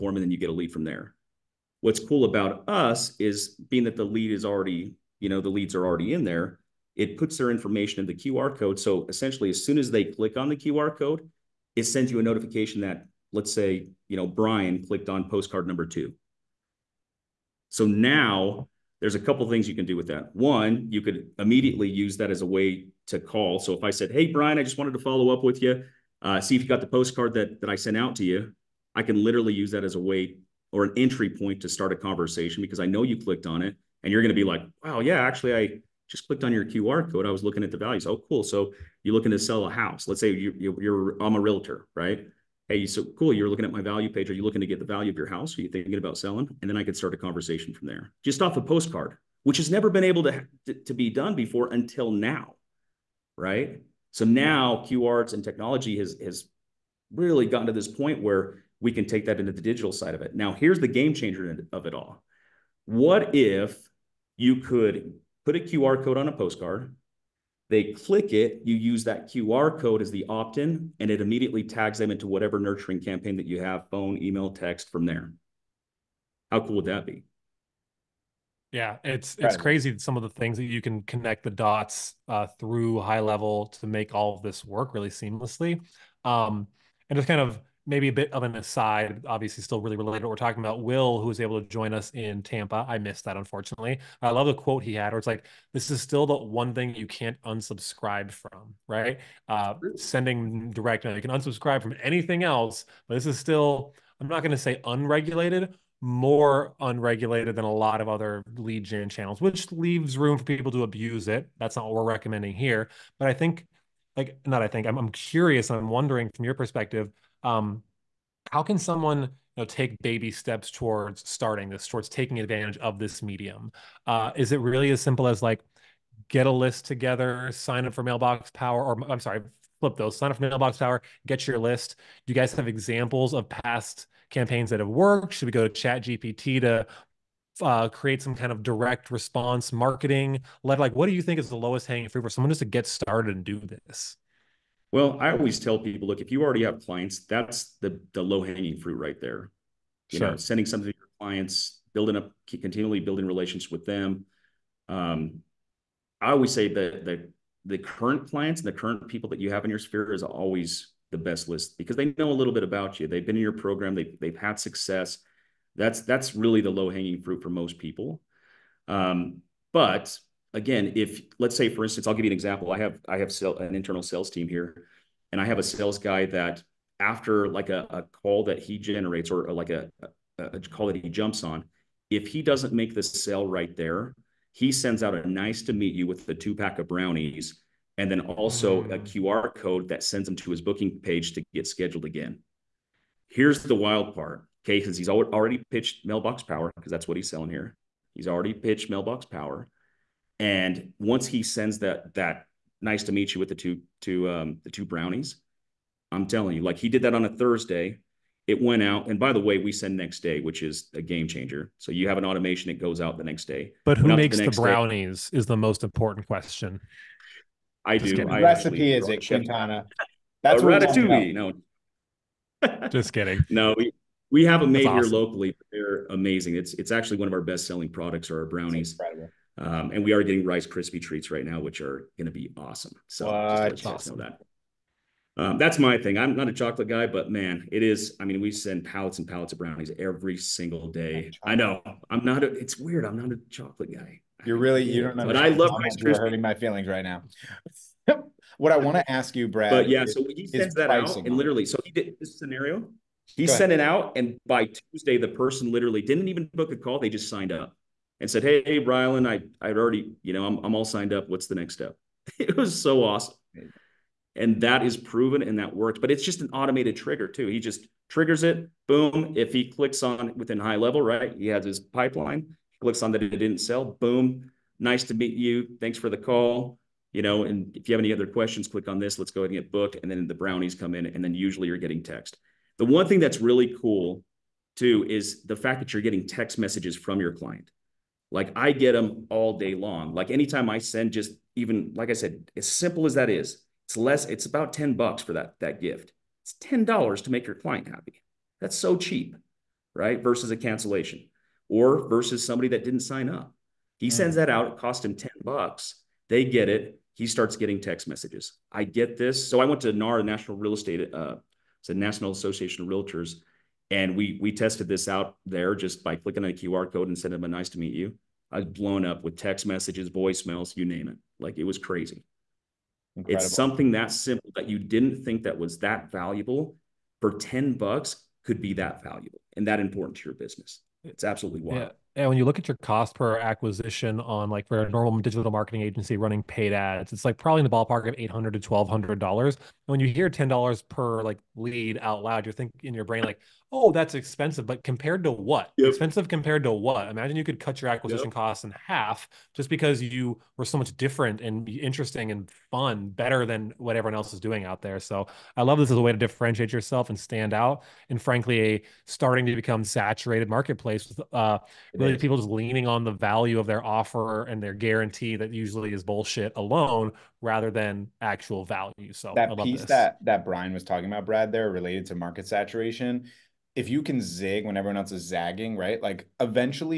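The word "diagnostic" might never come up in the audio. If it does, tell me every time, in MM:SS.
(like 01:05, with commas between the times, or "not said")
not said.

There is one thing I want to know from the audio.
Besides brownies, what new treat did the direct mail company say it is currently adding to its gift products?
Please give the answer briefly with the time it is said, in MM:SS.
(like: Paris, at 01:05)
Rice Krispie treats, at 03:50.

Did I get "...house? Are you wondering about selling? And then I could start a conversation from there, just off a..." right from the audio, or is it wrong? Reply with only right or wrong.
wrong.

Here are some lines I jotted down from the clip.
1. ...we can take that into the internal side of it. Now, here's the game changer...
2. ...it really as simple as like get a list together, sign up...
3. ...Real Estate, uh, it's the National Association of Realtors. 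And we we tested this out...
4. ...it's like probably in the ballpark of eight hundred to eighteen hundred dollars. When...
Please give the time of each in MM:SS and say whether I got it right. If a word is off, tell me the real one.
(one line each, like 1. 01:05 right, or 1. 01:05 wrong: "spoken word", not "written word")
1. 00:58 wrong: "digital", not "internal"
2. 02:04 right
3. 05:10 right
4. 05:37 wrong: "twelve", not "eighteen".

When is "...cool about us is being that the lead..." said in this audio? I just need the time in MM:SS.
00:01.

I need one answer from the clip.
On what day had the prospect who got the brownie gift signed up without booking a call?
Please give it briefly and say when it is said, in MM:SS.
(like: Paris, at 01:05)
Tuesday, at 04:14.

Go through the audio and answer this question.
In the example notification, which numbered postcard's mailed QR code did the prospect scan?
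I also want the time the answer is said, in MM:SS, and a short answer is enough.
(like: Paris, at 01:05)
2, at 00:15.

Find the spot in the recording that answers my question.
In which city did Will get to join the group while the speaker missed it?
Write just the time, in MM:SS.
01:32.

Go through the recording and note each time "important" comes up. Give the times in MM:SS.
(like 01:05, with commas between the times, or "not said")
03:35, 05:29.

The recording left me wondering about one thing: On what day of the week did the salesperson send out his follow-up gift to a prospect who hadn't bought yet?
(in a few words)
Thursday.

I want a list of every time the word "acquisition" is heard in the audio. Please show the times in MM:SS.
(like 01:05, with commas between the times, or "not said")
05:33, 05:47.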